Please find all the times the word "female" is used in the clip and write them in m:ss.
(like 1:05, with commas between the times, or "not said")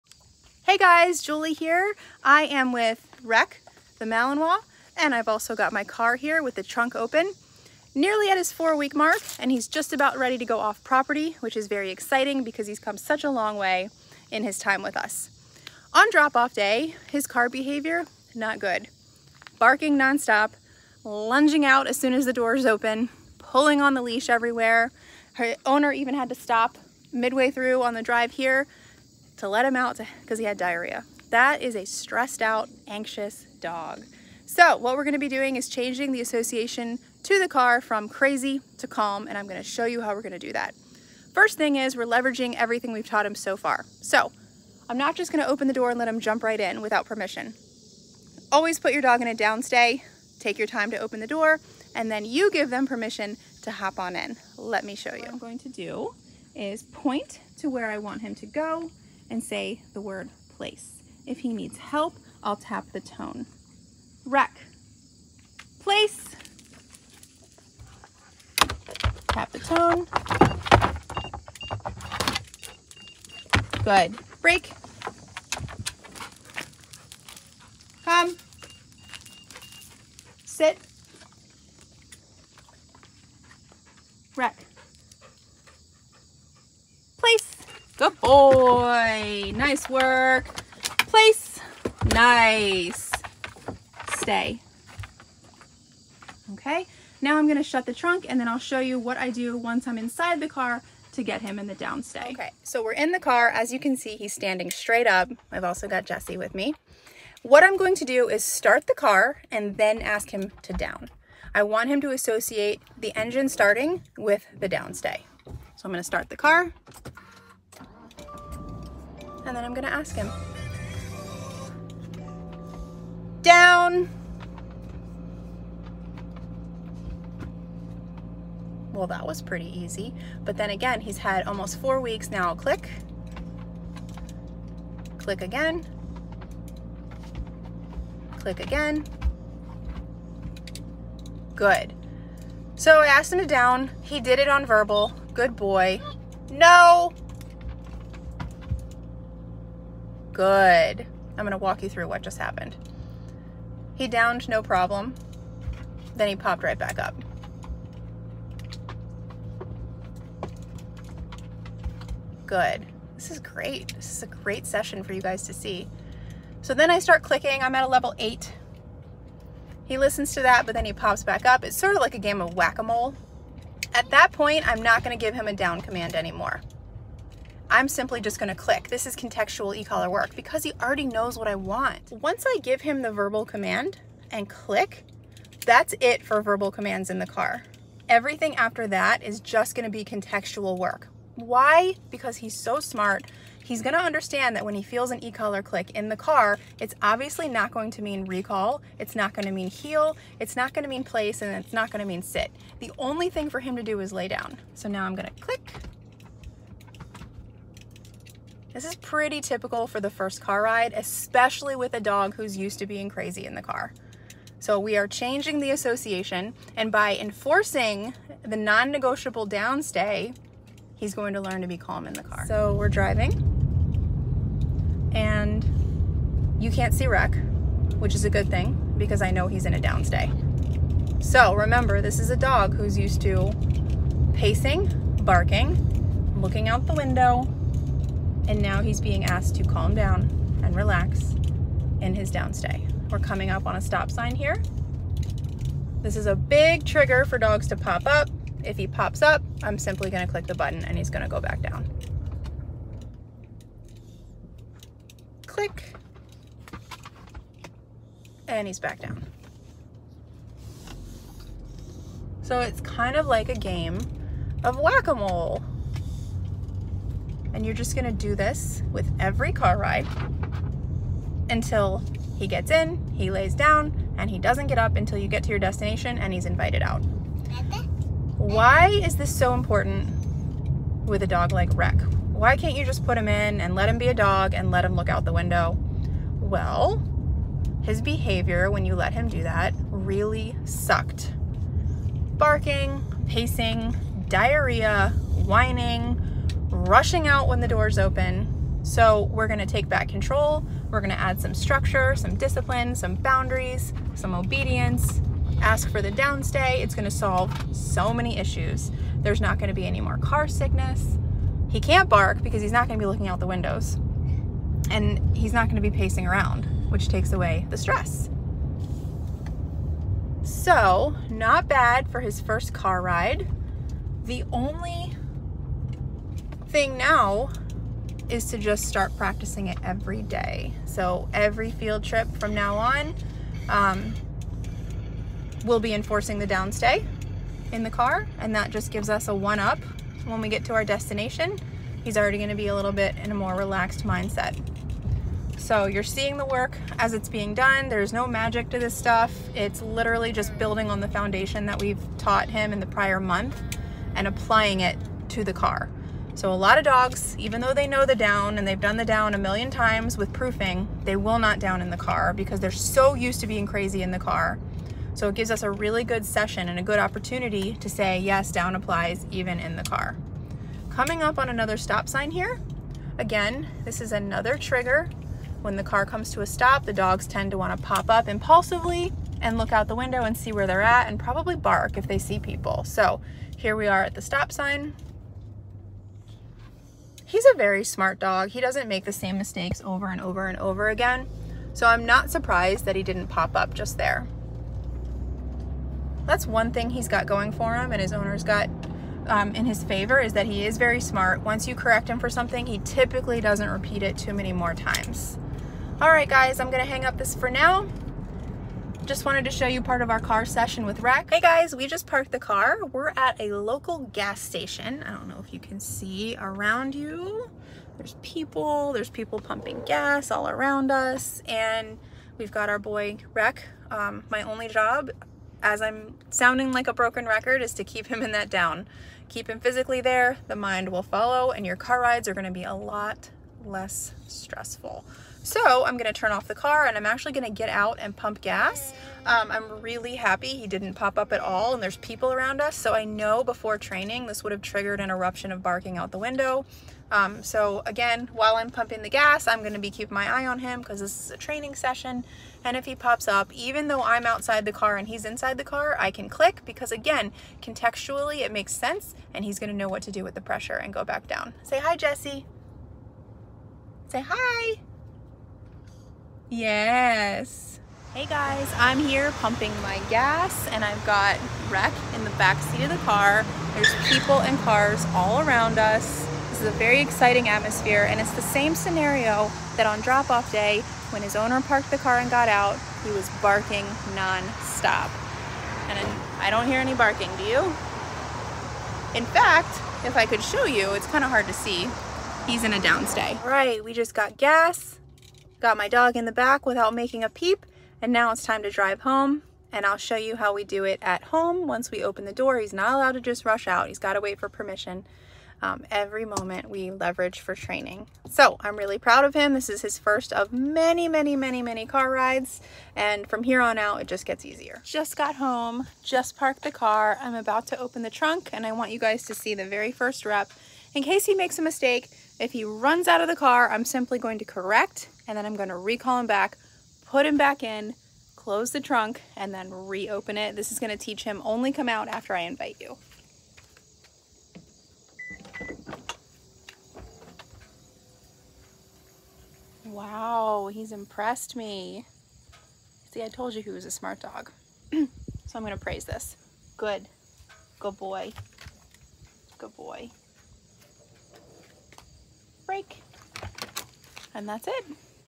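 not said.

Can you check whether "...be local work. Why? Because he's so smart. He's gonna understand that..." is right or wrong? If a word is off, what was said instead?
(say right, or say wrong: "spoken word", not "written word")
wrong: "contextual", not "local".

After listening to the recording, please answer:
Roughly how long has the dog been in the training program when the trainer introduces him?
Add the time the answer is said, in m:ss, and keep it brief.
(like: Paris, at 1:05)
four week mark, at 0:08.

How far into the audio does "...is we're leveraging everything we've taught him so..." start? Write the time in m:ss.
0:41.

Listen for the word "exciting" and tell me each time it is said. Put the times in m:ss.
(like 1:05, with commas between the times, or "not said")
0:11, 7:56.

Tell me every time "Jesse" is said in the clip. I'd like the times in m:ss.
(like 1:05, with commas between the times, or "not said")
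1:46, 7:41.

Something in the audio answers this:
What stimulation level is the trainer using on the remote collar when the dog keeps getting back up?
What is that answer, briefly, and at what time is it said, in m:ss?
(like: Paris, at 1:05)
8, at 2:47.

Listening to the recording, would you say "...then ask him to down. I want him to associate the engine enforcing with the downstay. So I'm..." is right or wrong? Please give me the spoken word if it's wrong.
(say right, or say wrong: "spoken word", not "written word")
wrong: "starting", not "enforcing".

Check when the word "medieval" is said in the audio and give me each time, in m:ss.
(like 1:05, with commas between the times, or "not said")
not said.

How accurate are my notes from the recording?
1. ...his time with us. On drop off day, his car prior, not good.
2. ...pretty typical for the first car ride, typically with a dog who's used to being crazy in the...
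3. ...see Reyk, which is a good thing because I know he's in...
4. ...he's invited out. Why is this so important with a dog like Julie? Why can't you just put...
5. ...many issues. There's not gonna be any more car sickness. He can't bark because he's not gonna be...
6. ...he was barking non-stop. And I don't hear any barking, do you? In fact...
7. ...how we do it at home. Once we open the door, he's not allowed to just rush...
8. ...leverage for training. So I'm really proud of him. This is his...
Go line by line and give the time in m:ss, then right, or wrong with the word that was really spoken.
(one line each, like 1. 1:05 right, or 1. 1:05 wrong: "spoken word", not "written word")
1. 0:14 wrong: "behavior", not "prior"
2. 3:28 wrong: "especially", not "typically"
3. 3:46 right
4. 4:36 wrong: "Reyk", not "Julie"
5. 5:08 right
6. 8:03 right
7. 8:20 right
8. 8:26 right.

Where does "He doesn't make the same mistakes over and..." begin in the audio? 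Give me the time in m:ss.
6:28.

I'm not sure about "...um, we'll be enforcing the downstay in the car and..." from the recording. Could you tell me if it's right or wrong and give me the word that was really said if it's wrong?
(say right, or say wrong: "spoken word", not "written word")
right.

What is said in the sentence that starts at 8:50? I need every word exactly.
This is going to teach him only come out after I invite you.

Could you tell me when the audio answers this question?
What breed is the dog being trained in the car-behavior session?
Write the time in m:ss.
0:04.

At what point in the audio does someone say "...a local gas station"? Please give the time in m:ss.
6:53.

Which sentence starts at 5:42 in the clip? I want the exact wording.
He's already gonna be a little bit in a more relaxed mindset.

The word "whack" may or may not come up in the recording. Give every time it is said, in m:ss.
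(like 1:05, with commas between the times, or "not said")
2:52, 4:24.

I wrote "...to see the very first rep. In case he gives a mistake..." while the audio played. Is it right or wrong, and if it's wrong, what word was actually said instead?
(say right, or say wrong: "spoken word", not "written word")
wrong: "makes", not "gives".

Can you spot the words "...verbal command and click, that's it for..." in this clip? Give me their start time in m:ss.
3:03.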